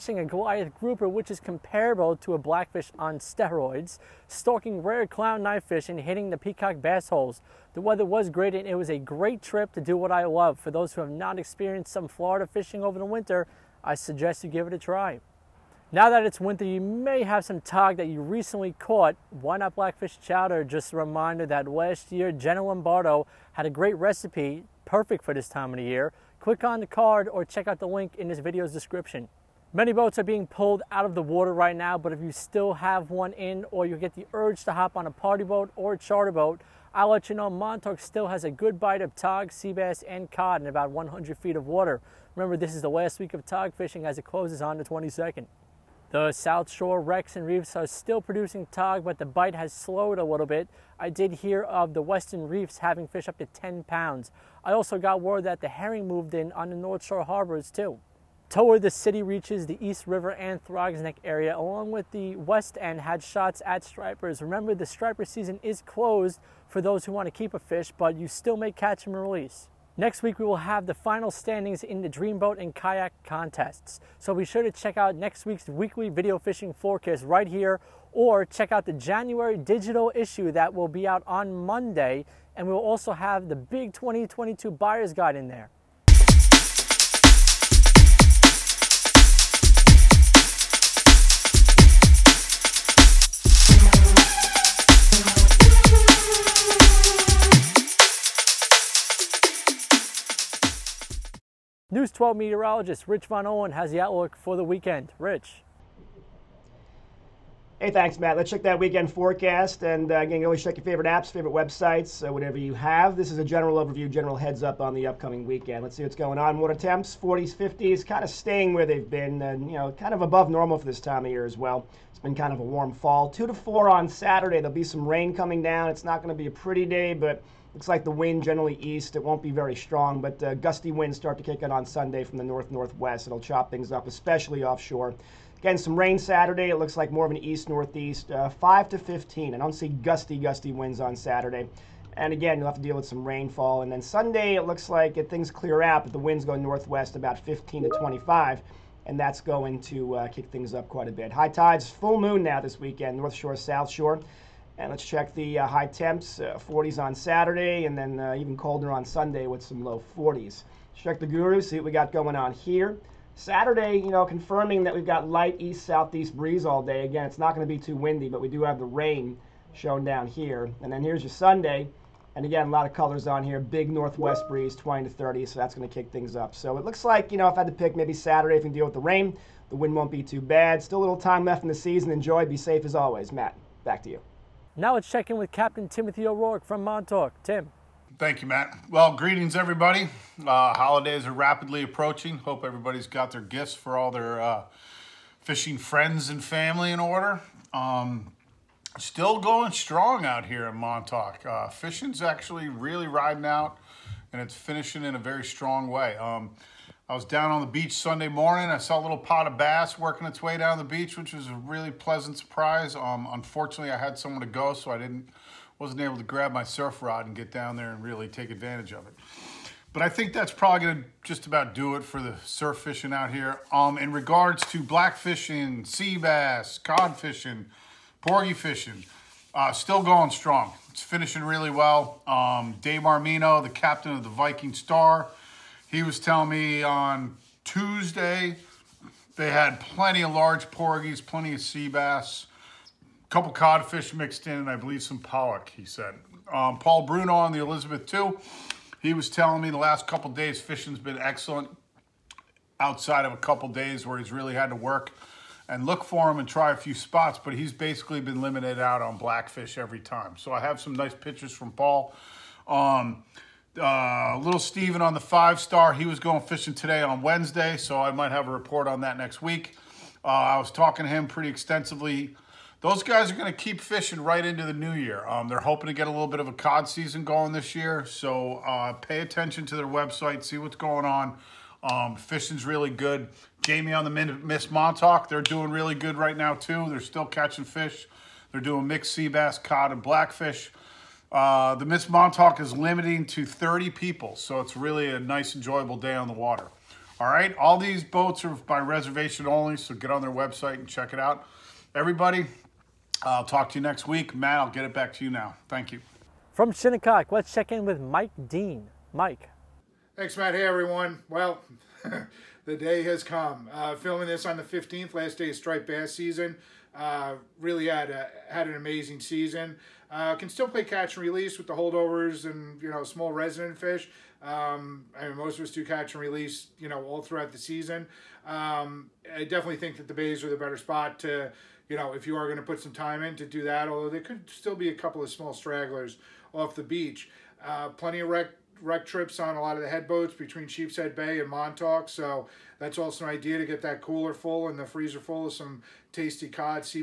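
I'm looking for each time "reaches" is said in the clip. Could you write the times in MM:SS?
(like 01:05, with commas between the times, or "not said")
00:59.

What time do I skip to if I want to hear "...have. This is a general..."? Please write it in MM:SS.
01:52.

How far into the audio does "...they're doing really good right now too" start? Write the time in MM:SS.
04:45.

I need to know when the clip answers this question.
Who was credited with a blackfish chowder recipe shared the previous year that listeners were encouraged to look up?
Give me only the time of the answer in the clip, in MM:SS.
00:22.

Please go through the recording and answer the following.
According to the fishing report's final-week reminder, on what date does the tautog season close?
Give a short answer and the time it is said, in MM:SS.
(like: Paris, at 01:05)
22nd, at 00:44.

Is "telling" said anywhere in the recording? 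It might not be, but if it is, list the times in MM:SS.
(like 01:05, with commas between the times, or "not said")
03:56, 04:09.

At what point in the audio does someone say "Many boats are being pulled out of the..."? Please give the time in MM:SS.
00:29.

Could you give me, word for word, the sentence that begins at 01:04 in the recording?
Remember, the striper season is closed for those who want to keep a fish, but you still may catch and release.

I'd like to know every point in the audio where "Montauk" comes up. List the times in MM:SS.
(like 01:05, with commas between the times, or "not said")
00:37, 03:06, 03:20, 04:44, 04:52, 05:41.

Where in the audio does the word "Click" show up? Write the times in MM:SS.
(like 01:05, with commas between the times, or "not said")
00:26.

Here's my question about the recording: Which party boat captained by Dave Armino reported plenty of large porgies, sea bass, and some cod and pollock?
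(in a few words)
Viking Star.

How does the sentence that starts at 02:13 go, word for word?
It'll chop things up, especially offshore.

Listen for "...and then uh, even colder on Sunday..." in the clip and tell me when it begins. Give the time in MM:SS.
02:37.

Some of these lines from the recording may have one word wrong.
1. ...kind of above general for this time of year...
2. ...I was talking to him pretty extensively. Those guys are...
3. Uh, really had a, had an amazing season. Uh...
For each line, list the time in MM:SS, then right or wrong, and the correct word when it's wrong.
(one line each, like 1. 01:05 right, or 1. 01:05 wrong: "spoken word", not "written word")
1. 01:59 wrong: "normal", not "general"
2. 04:30 right
3. 05:16 right.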